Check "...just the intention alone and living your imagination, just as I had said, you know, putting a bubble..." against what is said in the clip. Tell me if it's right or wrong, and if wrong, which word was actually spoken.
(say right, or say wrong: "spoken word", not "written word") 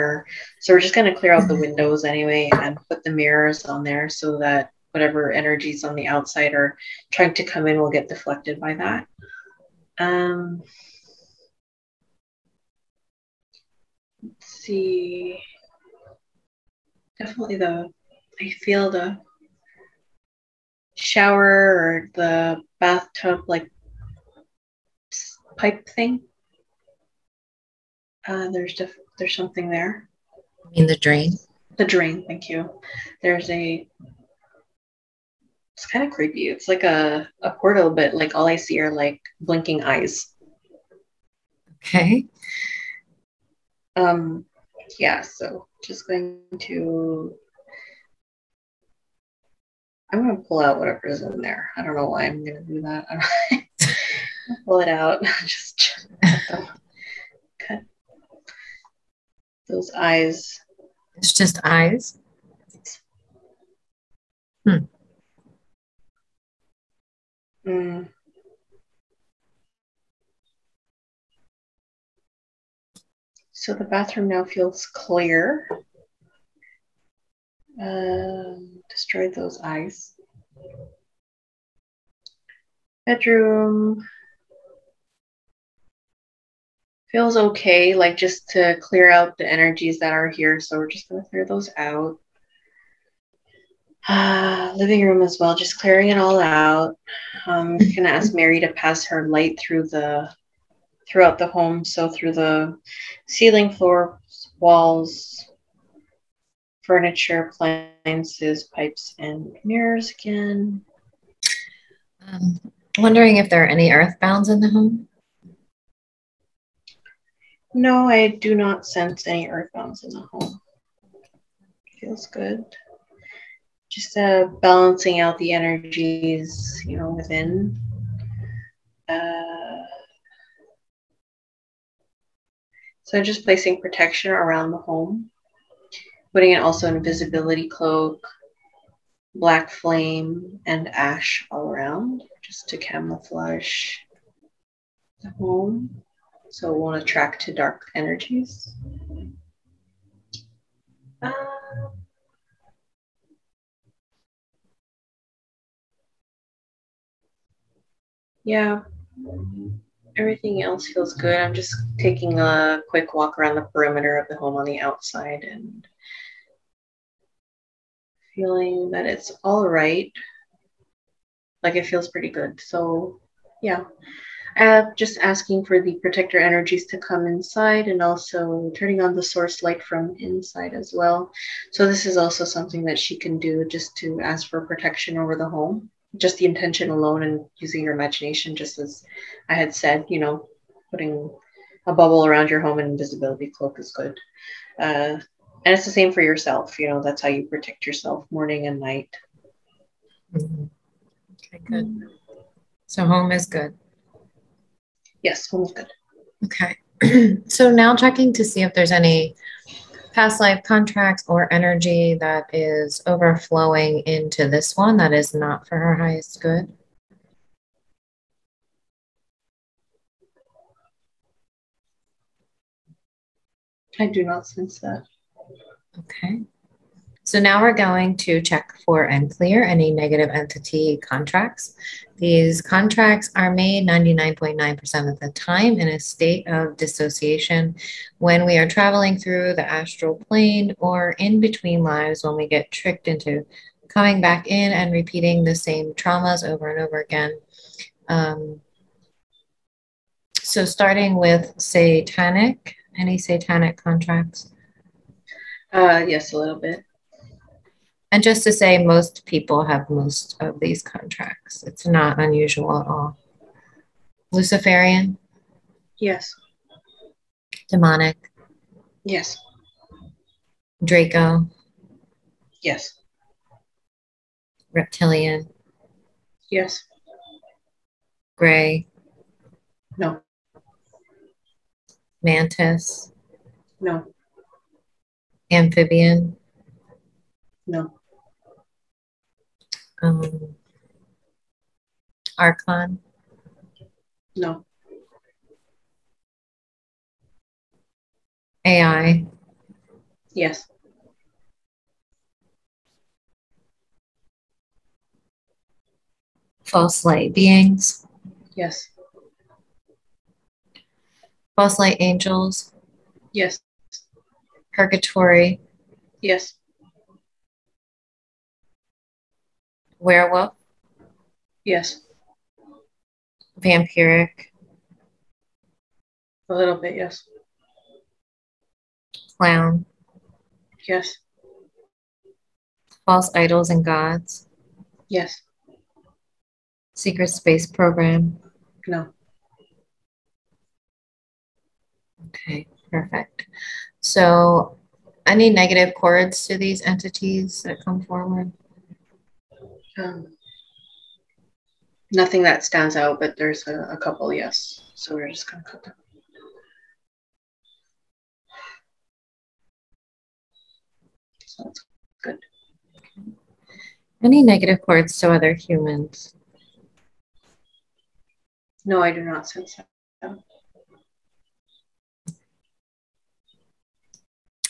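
wrong: "using", not "living".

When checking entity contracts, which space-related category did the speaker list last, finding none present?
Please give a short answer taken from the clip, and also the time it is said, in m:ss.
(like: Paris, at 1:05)
Secret space program, at 5:36.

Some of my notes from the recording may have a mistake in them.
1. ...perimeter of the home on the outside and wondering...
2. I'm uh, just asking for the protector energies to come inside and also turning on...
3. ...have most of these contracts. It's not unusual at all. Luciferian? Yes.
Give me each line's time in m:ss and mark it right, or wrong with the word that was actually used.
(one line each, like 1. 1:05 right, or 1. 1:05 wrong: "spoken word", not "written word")
1. 2:43 wrong: "feeling", not "wondering"
2. 2:54 right
3. 4:19 right.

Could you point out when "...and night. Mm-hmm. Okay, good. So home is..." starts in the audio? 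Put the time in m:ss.
3:18.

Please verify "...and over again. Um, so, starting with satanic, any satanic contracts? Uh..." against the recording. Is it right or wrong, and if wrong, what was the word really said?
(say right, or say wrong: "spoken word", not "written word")
right.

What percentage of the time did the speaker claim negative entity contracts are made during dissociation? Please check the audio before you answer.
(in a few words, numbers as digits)
99.9%.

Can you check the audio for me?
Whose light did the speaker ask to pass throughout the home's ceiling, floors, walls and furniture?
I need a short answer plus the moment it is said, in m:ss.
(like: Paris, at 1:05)
Mary, at 1:38.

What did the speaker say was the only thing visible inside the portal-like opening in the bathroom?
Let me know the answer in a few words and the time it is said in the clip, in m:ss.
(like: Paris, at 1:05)
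Blinking eyes, at 0:39.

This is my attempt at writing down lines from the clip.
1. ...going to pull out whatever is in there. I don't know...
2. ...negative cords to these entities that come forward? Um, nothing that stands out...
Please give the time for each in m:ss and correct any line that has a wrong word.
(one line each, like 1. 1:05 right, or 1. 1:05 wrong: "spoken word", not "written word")
1. 0:50 right
2. 5:45 right.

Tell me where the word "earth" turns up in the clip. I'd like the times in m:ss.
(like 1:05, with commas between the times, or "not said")
1:53, 1:59.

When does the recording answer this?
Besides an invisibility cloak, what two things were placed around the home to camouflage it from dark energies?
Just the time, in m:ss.
2:19.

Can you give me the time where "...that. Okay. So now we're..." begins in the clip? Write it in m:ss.
3:44.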